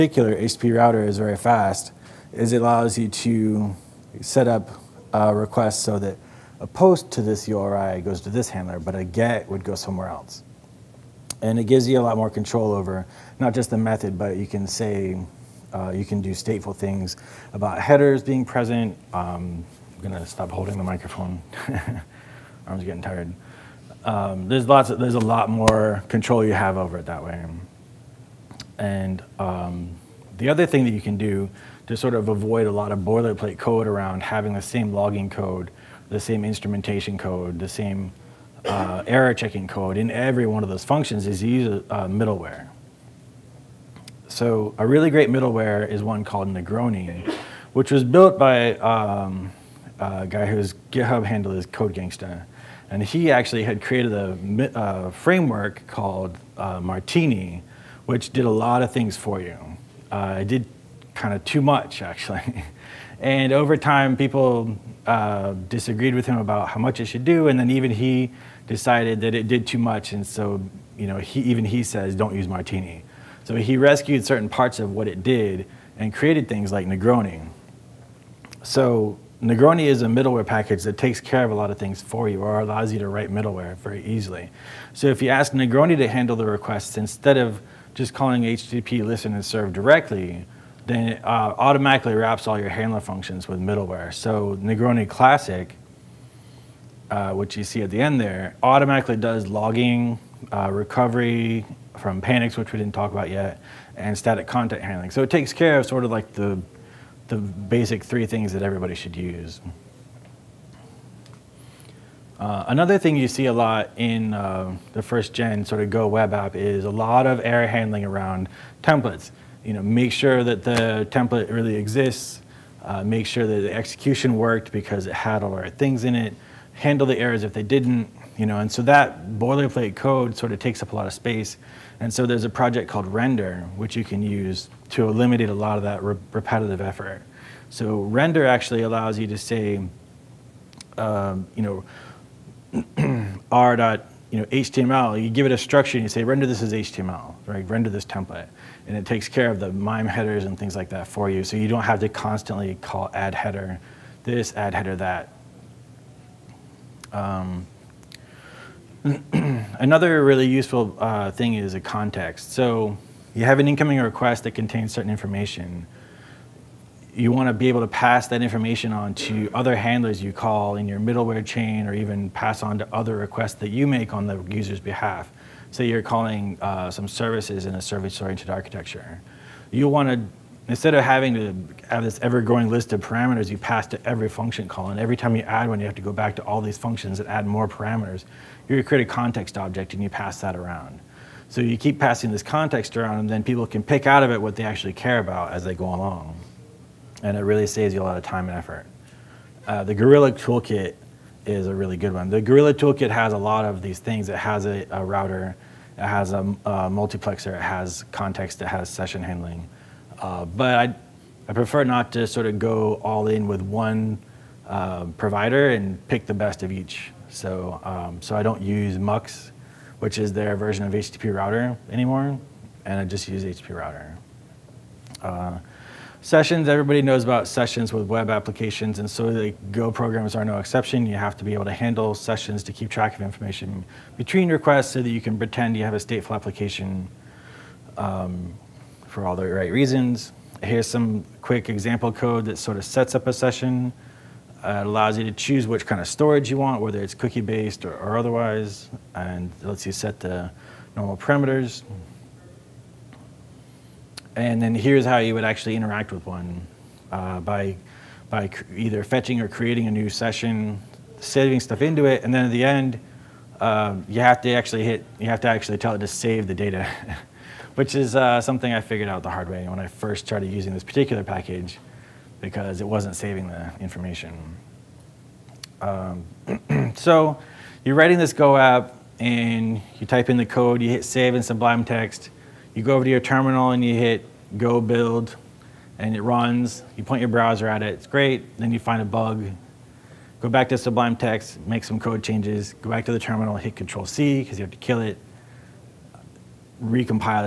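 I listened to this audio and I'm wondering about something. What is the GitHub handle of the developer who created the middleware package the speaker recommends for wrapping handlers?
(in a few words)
CodeGangsta.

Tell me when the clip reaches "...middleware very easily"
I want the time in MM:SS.
01:23.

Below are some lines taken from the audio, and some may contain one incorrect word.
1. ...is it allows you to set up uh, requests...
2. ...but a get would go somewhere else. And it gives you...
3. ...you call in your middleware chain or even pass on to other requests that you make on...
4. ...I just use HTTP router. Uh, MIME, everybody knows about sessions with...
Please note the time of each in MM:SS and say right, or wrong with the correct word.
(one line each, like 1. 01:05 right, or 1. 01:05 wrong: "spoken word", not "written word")
1. 00:02 right
2. 00:08 right
3. 02:50 right
4. 03:42 wrong: "Sessions", not "MIME".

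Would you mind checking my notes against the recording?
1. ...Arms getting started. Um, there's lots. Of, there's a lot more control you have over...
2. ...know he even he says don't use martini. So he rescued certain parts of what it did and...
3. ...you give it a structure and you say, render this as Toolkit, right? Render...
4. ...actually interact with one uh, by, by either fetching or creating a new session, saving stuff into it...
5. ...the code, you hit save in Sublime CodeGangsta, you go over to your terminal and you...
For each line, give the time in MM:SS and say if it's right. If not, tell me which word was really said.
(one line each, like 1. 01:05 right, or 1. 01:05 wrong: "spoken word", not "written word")
1. 00:22 wrong: "tired", not "started"
2. 01:11 right
3. 02:25 wrong: "HTML", not "Toolkit"
4. 04:15 right
5. 04:40 wrong: "Text", not "CodeGangsta".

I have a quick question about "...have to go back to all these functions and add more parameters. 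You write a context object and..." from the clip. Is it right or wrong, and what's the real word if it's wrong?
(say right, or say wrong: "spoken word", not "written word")
wrong: "create", not "write".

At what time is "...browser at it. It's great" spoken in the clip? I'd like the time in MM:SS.
04:47.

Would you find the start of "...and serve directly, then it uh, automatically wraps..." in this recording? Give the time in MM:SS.
01:29.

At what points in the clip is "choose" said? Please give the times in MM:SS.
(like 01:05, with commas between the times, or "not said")
04:05.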